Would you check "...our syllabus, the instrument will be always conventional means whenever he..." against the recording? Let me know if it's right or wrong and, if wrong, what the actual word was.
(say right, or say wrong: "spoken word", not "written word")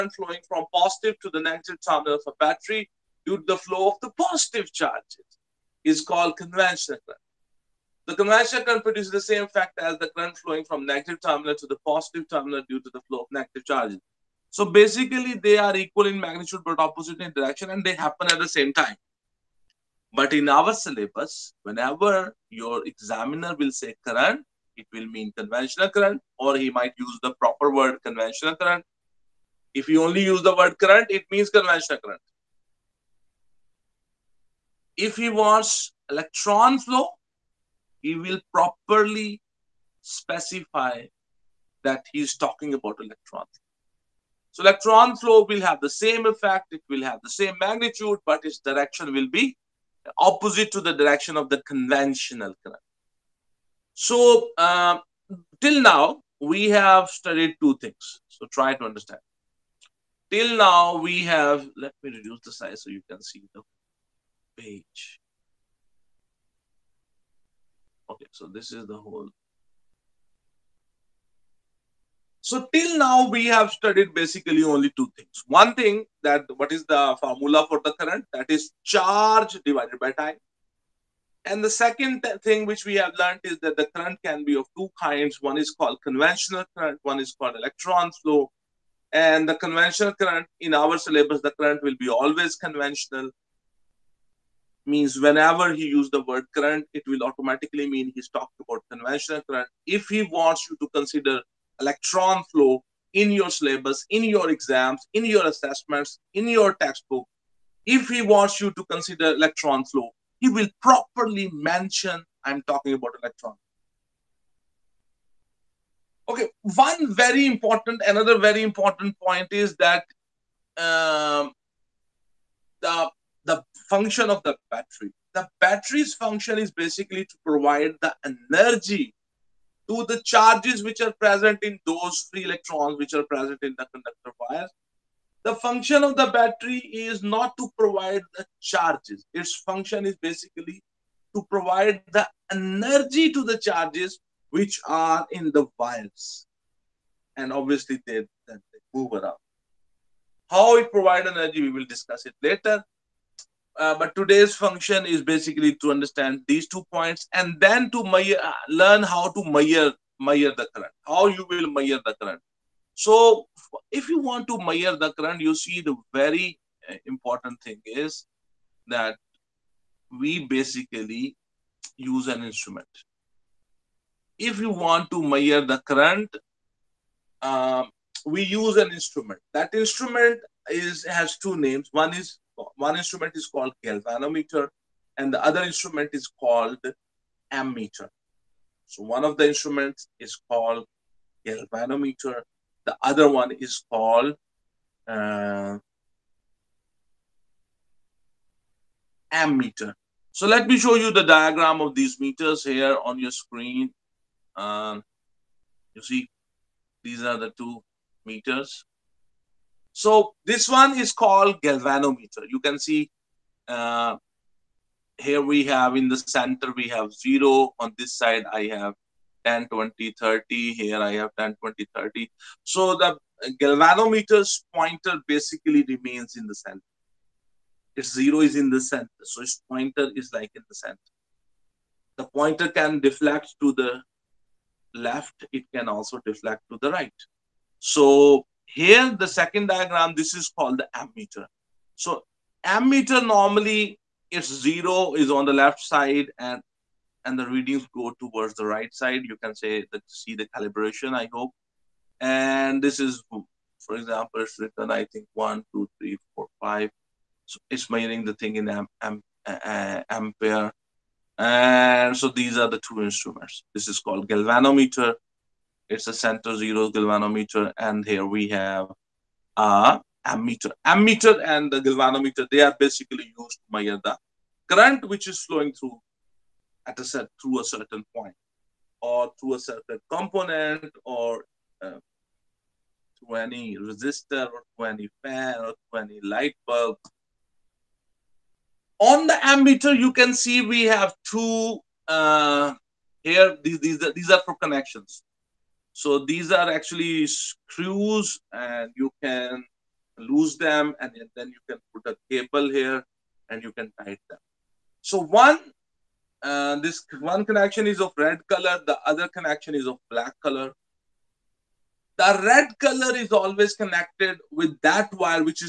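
wrong: "current", not "instrument".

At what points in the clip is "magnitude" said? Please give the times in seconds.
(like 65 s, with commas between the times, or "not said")
16 s, 47 s.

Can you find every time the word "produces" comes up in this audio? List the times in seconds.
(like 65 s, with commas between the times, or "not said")
8 s.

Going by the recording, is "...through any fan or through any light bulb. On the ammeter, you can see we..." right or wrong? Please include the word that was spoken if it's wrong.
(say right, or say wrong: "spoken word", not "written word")
right.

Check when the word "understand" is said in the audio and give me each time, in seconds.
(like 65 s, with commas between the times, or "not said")
58 s, 155 s.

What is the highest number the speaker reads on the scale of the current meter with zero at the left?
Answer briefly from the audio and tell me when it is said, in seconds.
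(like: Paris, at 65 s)
5, at 256 s.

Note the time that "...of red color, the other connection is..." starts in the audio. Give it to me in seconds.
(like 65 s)
308 s.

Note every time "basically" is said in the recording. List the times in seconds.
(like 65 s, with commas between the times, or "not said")
14 s, 74 s, 126 s, 140 s, 155 s, 170 s, 225 s, 272 s.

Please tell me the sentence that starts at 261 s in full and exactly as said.
And so these are the two instruments.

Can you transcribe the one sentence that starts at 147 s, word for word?
And obviously, they, they move around.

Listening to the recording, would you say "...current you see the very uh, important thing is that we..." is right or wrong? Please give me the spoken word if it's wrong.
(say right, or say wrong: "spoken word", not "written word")
right.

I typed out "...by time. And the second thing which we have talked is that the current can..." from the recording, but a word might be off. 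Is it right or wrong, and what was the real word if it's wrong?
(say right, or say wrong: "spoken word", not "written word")
wrong: "learned", not "talked".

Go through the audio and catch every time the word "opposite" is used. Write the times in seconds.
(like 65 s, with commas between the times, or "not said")
16 s, 50 s.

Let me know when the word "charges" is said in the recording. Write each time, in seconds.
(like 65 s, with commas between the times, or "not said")
4 s, 13 s, 78 s, 130 s, 138 s, 143 s.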